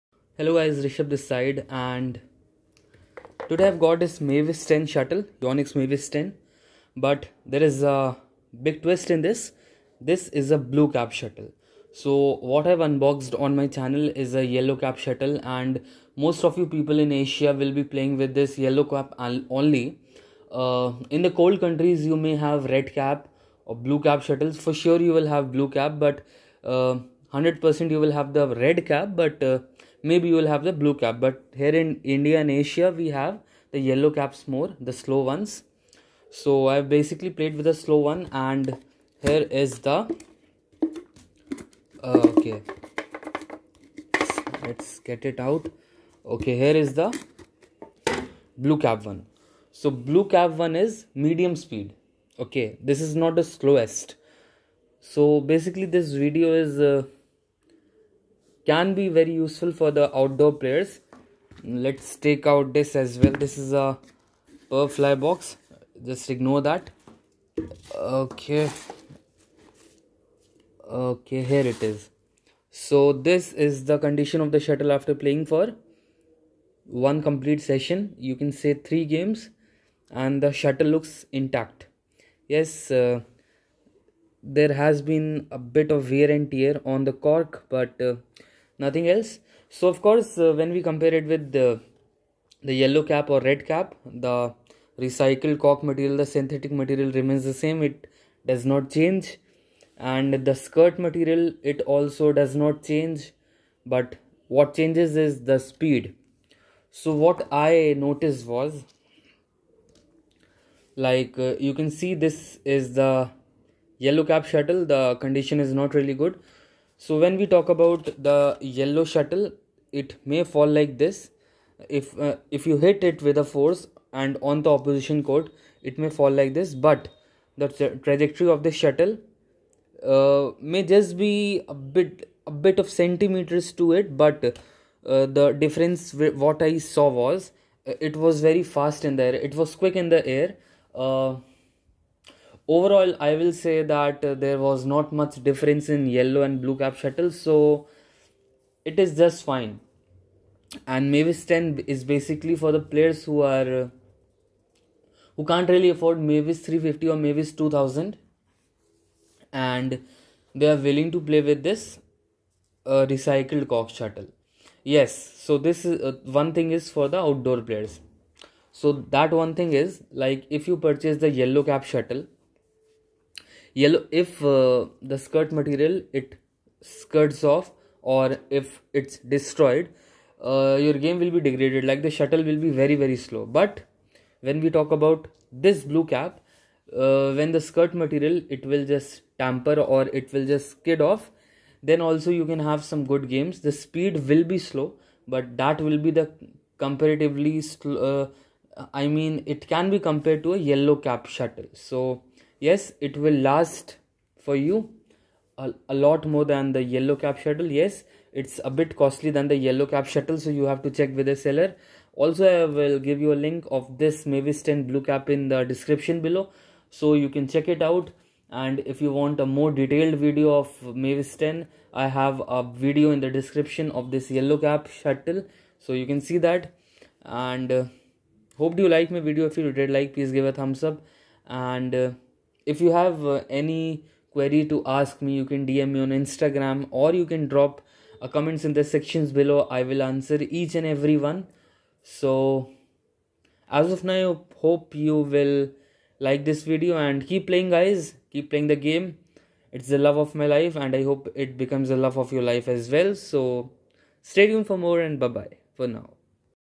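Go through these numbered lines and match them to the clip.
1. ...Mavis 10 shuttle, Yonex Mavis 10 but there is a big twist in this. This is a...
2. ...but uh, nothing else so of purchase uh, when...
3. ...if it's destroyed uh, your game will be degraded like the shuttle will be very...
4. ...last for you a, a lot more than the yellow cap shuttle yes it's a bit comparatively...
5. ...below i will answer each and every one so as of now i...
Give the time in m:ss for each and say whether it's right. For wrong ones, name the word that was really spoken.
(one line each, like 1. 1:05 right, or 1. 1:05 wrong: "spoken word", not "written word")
1. 0:04 right
2. 1:27 wrong: "course", not "purchase"
3. 2:58 right
4. 3:23 wrong: "costly", not "comparatively"
5. 3:59 right.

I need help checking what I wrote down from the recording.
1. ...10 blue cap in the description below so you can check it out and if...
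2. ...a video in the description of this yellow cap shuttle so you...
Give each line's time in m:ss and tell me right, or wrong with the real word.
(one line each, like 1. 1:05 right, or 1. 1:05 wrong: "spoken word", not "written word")
1. 3:34 right
2. 3:42 right.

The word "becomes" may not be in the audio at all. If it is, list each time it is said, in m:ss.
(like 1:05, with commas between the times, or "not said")
4:11.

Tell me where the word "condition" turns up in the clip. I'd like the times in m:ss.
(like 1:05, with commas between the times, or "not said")
1:13, 1:55.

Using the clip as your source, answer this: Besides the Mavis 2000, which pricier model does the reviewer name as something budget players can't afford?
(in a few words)
Mavis 350.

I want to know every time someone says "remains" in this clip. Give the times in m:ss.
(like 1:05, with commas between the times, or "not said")
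1:37.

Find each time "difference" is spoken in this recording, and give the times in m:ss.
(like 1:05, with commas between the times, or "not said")
2:15, 2:25.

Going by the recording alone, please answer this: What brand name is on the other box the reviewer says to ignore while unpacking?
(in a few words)
Perfly.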